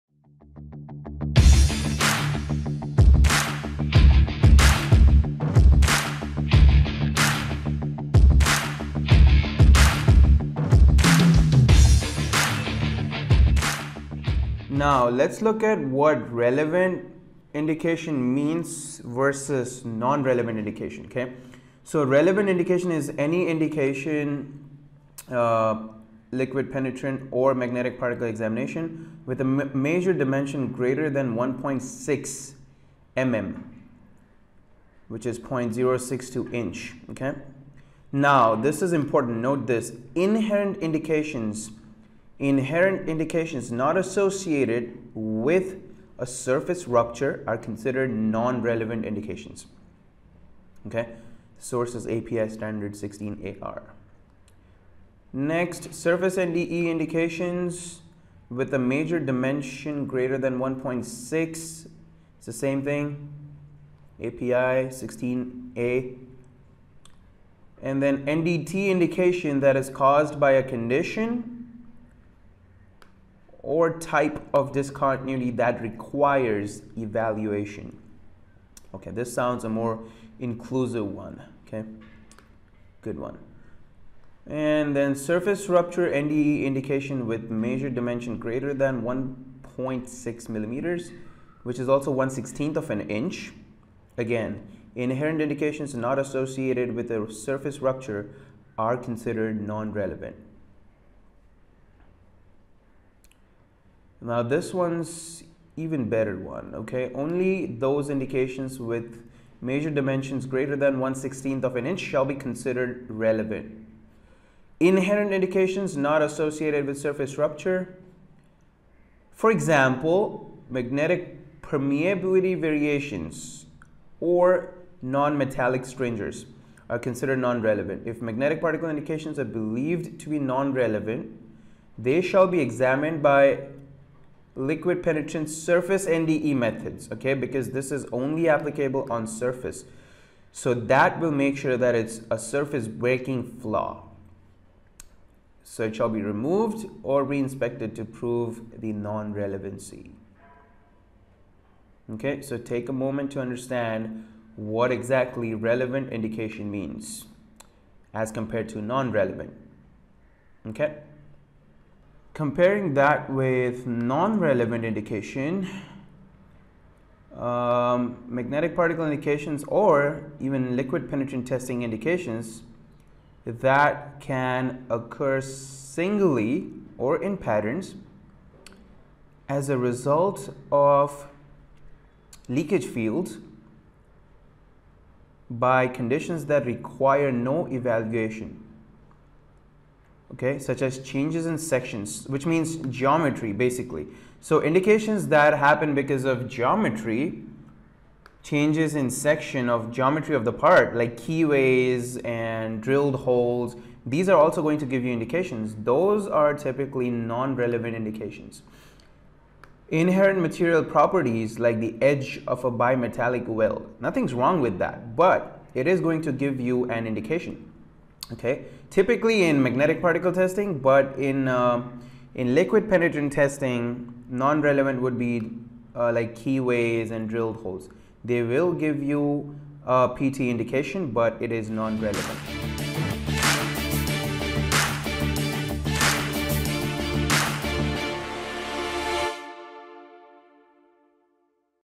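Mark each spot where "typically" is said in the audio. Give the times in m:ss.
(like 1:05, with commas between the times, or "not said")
3:26, 3:38.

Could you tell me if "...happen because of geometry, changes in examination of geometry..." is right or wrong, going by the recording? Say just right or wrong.
wrong.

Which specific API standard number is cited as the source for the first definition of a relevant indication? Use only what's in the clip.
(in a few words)
API 16AR.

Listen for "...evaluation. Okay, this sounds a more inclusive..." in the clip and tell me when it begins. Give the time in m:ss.
1:16.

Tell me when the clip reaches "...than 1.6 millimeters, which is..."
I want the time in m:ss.
1:28.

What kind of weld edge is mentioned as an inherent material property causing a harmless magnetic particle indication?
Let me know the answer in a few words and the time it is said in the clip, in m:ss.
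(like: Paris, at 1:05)
bimetallic weld, at 3:32.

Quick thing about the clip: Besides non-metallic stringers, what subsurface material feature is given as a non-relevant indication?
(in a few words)
magnetic permeability variations.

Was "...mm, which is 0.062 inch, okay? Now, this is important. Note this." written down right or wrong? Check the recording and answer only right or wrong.
right.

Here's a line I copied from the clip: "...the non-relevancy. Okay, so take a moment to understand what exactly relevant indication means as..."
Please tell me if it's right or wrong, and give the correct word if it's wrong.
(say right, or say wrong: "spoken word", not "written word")
right.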